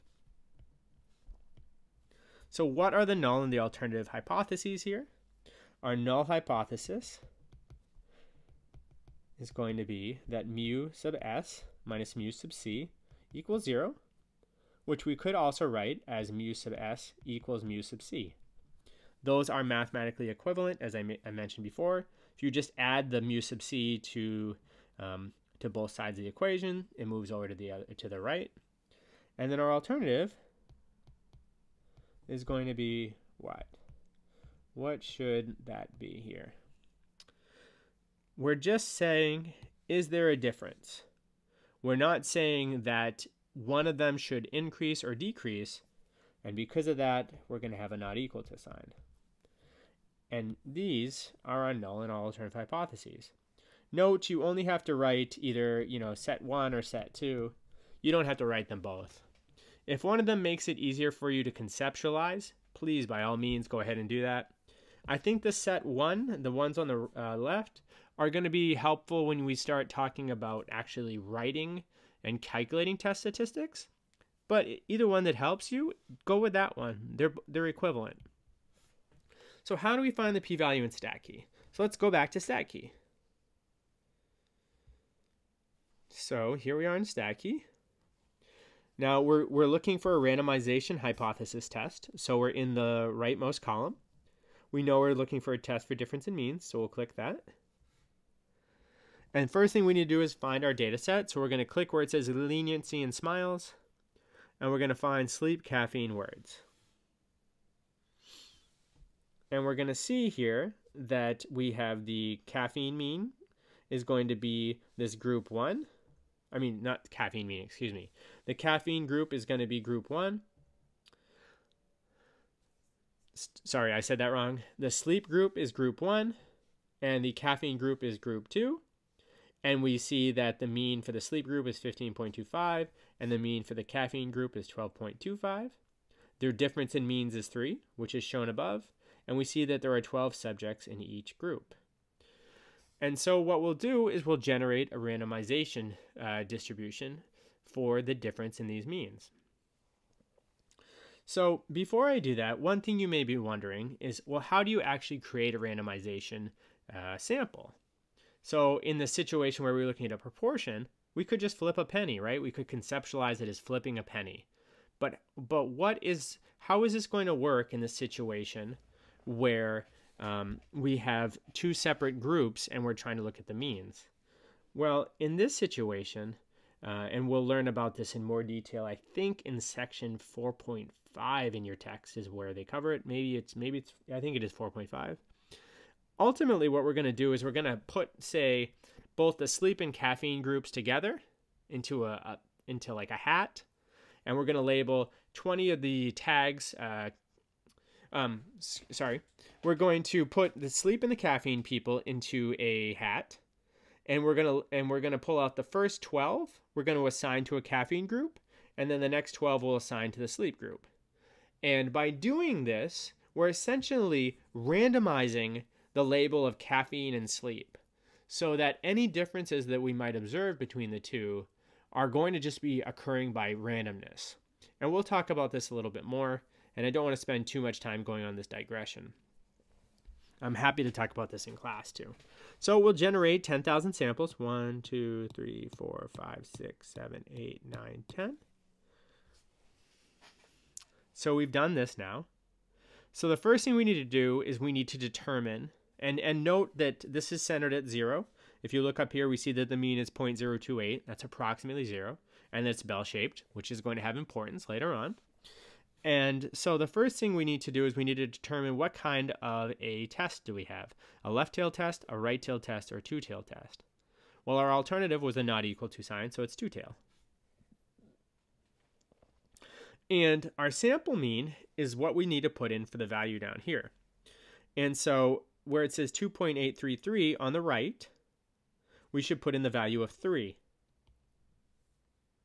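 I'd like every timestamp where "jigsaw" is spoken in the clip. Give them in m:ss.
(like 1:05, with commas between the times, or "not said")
not said.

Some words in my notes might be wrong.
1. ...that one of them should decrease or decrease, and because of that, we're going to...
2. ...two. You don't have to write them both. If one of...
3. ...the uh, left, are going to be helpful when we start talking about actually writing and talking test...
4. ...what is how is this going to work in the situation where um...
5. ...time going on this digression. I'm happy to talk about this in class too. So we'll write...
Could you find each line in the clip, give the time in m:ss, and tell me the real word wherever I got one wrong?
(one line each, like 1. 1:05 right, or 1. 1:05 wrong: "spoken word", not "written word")
1. 0:42 wrong: "increase", not "decrease"
2. 0:57 right
3. 1:06 wrong: "calculating", not "talking"
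4. 2:45 right
5. 3:47 wrong: "generate", not "write".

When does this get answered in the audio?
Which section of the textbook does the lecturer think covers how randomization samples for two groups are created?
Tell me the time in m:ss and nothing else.
2:59.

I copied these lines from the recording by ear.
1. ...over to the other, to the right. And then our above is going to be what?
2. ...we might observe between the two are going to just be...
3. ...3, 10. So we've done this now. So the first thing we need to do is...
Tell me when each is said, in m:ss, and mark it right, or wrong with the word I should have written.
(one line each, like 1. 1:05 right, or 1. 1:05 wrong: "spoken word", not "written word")
1. 0:27 wrong: "alternative", not "above"
2. 3:39 right
3. 3:57 wrong: "9", not "3".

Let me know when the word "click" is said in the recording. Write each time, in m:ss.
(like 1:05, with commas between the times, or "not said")
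1:36, 1:41.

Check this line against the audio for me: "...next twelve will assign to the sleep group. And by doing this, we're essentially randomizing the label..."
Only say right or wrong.
right.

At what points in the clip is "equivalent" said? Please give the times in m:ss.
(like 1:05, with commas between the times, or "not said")
0:20, 1:17.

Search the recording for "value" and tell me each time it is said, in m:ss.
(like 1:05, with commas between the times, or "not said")
1:20, 4:33, 4:39.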